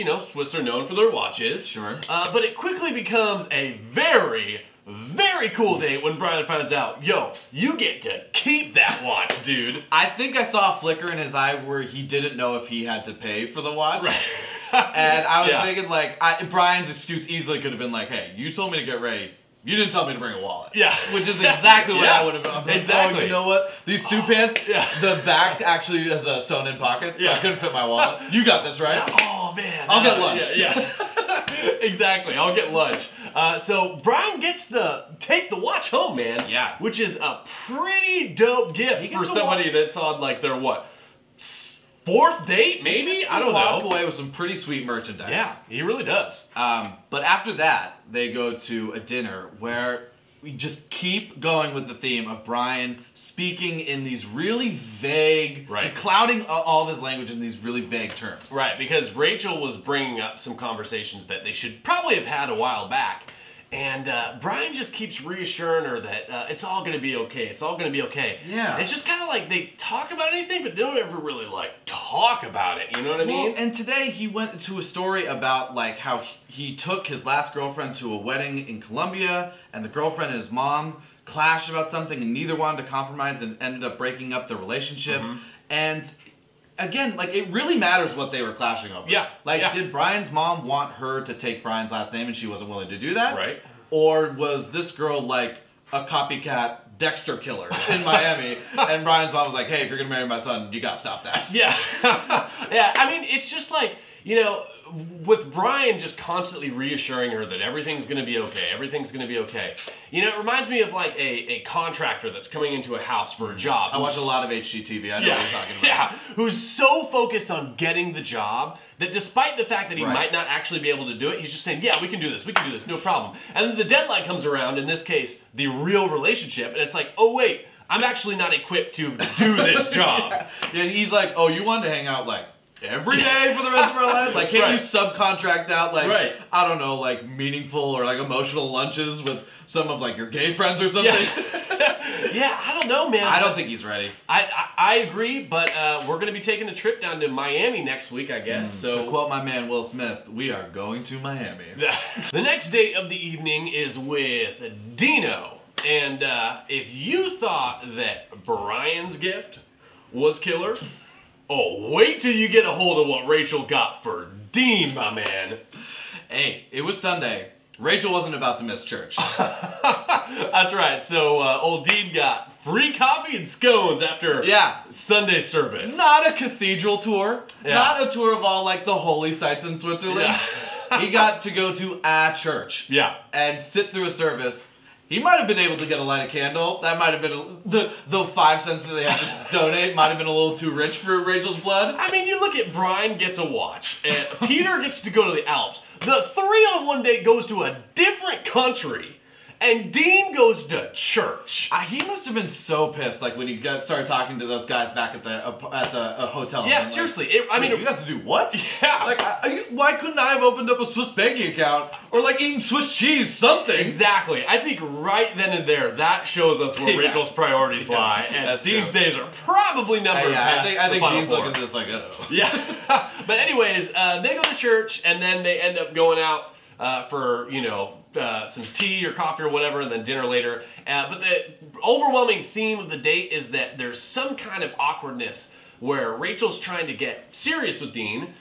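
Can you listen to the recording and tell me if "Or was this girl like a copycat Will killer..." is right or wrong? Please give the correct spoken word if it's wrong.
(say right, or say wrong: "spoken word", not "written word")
wrong: "Dexter", not "Will".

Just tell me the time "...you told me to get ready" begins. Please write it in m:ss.
0:18.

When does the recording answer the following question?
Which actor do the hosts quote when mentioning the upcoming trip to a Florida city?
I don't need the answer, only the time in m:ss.
2:29.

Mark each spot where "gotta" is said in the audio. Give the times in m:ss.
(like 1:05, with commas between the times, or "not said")
1:40.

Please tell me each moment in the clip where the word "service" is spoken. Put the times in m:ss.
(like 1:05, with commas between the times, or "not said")
2:55, 3:04.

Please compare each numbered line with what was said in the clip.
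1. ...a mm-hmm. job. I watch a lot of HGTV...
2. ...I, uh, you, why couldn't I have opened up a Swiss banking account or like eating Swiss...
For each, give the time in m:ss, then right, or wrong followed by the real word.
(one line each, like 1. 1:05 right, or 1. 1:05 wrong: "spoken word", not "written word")
1. 1:53 right
2. 3:29 right.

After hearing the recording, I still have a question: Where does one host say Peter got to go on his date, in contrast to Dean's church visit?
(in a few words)
the Alps.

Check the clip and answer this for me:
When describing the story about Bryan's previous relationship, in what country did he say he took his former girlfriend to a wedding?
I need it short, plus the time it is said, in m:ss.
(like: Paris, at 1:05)
Colombia, at 1:18.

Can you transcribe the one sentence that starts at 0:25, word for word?
the back actually has a sewn in pocket, so yeah.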